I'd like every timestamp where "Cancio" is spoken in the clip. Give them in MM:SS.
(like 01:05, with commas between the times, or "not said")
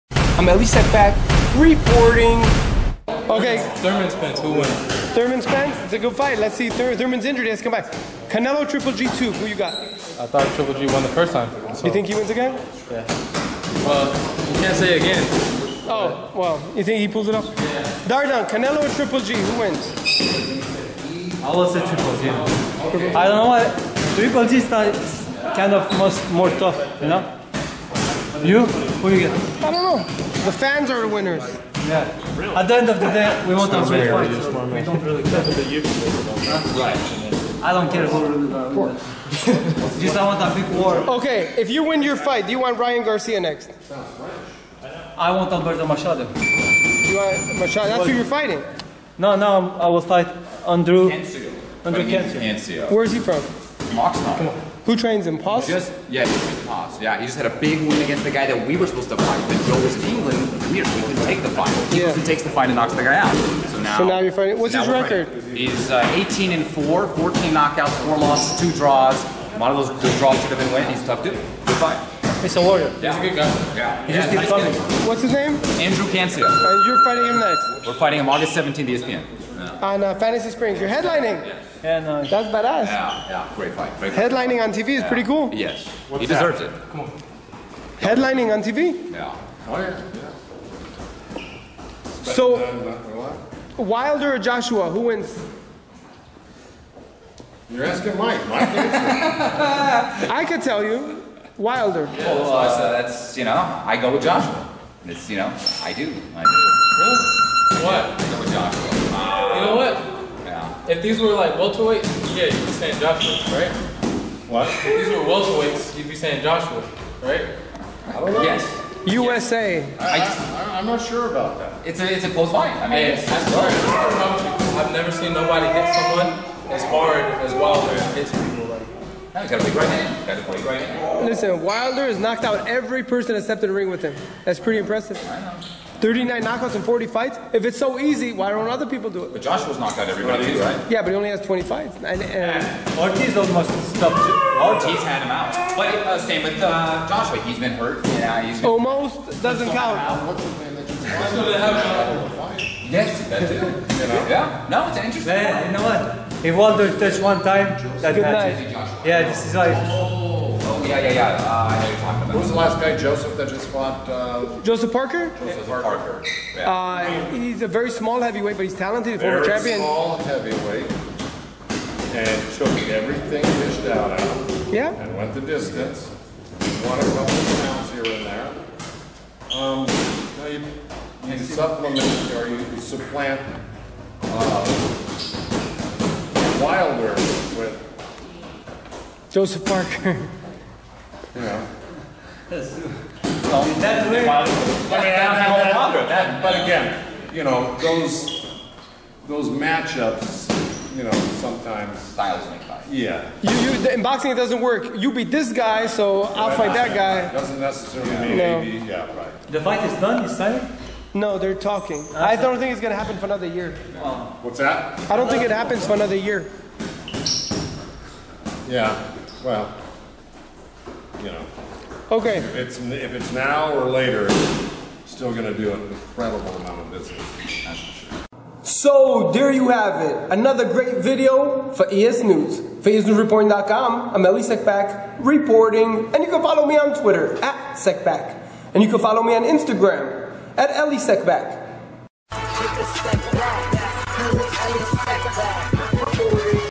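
00:52, 01:16.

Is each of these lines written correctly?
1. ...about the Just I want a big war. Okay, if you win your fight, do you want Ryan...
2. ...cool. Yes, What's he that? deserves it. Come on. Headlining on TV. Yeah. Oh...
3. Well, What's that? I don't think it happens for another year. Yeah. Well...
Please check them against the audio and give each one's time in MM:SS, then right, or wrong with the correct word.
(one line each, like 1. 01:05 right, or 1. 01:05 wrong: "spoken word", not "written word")
1. 00:38 right
2. 01:25 right
3. 03:33 right.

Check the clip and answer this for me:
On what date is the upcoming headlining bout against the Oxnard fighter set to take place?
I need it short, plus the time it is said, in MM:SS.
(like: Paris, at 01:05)
August 17th, at 01:18.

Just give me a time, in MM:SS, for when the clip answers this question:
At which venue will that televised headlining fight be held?
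01:20.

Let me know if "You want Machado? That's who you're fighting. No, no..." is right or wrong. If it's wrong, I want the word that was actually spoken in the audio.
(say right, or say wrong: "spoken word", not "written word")
right.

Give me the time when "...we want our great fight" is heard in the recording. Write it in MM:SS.
00:33.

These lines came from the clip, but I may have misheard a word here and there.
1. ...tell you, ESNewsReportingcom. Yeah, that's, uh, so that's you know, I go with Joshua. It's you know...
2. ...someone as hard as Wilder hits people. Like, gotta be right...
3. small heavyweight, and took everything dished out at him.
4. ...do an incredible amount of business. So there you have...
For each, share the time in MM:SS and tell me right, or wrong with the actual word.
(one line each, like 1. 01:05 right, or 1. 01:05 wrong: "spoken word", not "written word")
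1. 01:40 wrong: "Wilder", not "ESNewsReportingcom"
2. 02:05 right
3. 02:49 right
4. 03:45 right.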